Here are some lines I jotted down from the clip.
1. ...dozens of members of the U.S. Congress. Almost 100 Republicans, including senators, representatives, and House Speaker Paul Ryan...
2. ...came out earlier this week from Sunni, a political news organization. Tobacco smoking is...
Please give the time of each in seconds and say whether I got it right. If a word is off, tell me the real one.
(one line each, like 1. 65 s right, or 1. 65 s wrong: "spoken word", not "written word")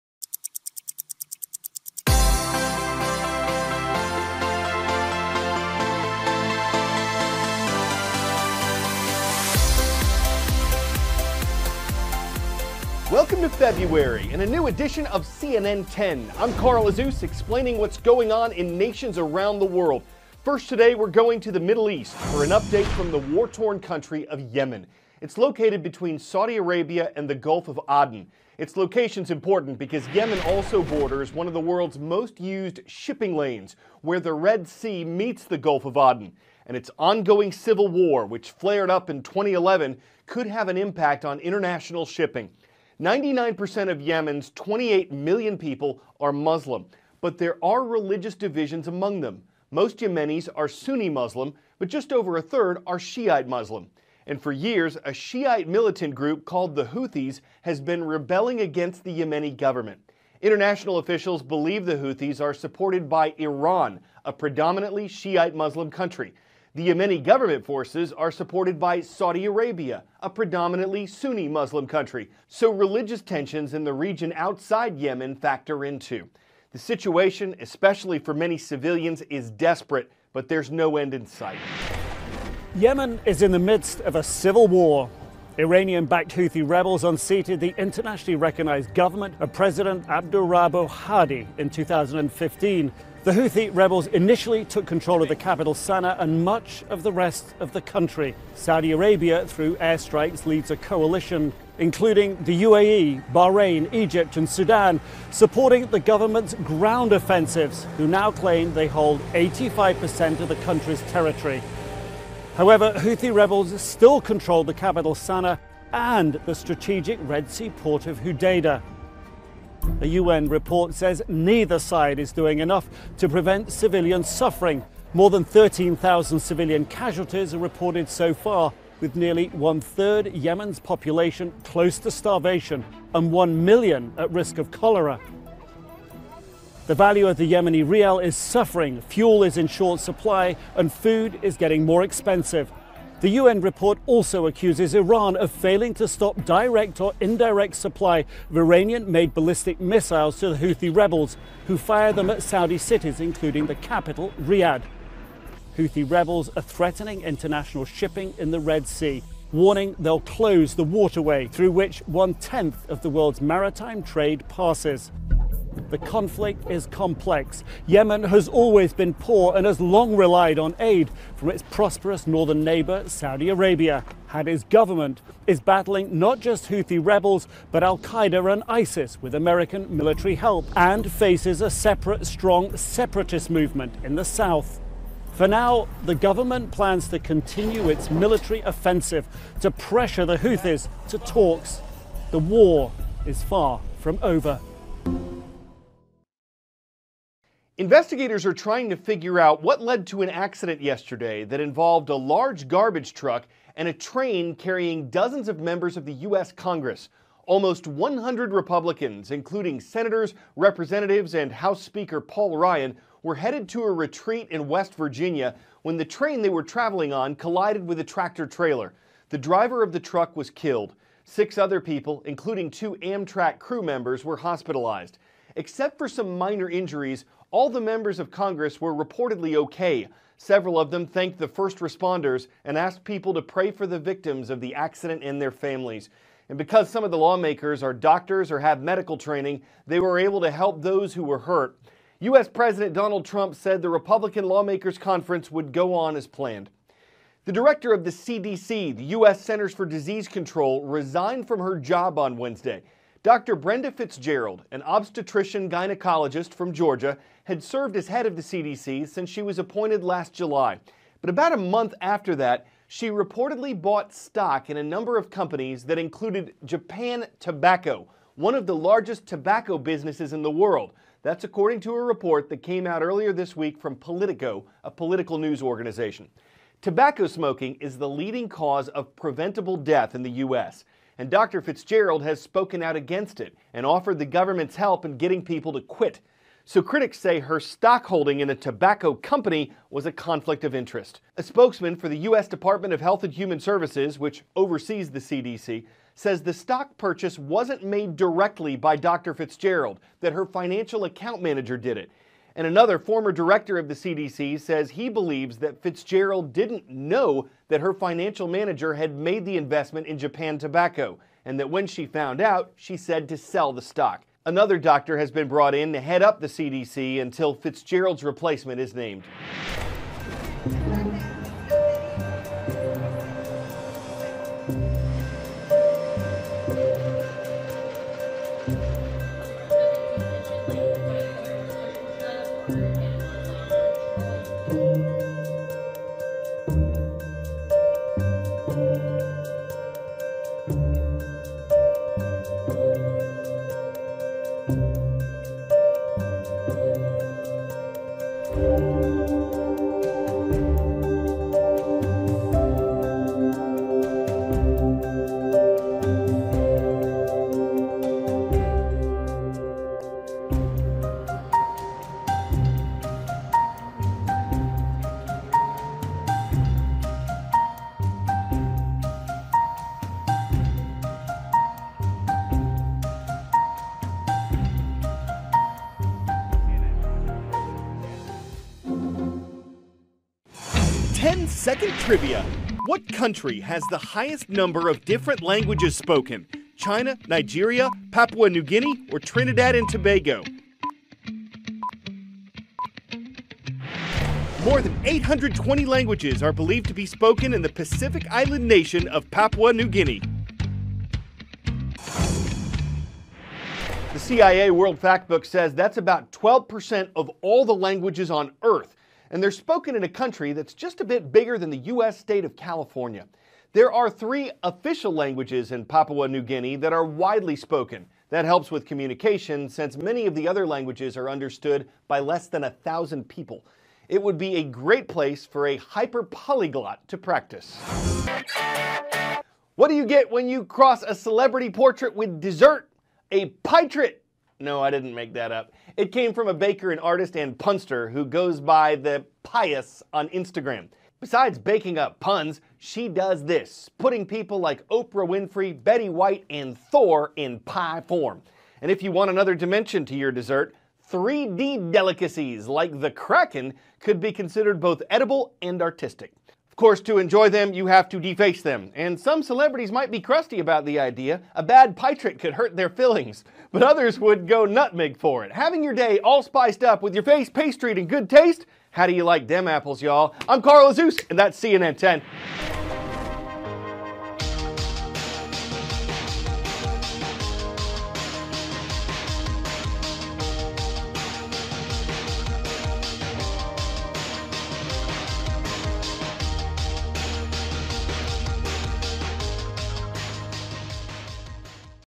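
1. 205 s right
2. 272 s wrong: "Politico", not "Sunni".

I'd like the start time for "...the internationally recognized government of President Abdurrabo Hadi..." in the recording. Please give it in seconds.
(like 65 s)
87 s.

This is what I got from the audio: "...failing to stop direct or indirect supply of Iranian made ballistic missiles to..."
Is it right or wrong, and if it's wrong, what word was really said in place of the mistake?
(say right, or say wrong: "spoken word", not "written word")
right.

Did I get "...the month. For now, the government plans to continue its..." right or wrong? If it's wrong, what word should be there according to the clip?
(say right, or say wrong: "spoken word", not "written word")
wrong: "south", not "month".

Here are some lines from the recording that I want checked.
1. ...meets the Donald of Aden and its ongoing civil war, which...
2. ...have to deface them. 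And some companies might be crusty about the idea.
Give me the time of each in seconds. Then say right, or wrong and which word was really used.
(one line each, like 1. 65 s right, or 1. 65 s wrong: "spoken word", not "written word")
1. 35 s wrong: "Gulf", not "Donald"
2. 457 s wrong: "celebrities", not "companies".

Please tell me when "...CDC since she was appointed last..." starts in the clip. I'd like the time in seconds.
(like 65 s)
258 s.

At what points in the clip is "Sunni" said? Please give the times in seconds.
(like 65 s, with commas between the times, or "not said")
50 s, 71 s.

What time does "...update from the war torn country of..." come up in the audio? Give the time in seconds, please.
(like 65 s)
22 s.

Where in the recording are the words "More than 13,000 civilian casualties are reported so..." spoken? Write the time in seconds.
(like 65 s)
125 s.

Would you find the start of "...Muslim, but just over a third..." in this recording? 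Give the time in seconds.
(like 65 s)
51 s.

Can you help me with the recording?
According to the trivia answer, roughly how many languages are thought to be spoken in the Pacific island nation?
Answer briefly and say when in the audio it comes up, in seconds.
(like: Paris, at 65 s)
More than 820, at 394 s.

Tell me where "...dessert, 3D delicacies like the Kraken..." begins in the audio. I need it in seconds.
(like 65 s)
450 s.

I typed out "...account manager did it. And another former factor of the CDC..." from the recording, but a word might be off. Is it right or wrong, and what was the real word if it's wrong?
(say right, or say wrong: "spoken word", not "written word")
wrong: "director", not "factor".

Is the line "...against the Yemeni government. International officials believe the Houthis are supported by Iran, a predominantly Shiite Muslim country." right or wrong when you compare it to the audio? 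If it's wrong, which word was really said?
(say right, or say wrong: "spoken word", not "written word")
right.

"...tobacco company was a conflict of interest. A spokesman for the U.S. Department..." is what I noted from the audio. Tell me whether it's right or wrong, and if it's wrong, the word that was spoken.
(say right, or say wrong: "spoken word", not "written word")
right.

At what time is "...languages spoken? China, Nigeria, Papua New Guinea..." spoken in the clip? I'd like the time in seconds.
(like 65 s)
385 s.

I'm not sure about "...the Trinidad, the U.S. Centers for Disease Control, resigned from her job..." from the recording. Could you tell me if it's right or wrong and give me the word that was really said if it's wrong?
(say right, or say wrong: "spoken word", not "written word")
wrong: "CDC", not "Trinidad".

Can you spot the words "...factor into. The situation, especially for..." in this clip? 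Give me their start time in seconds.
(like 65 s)
75 s.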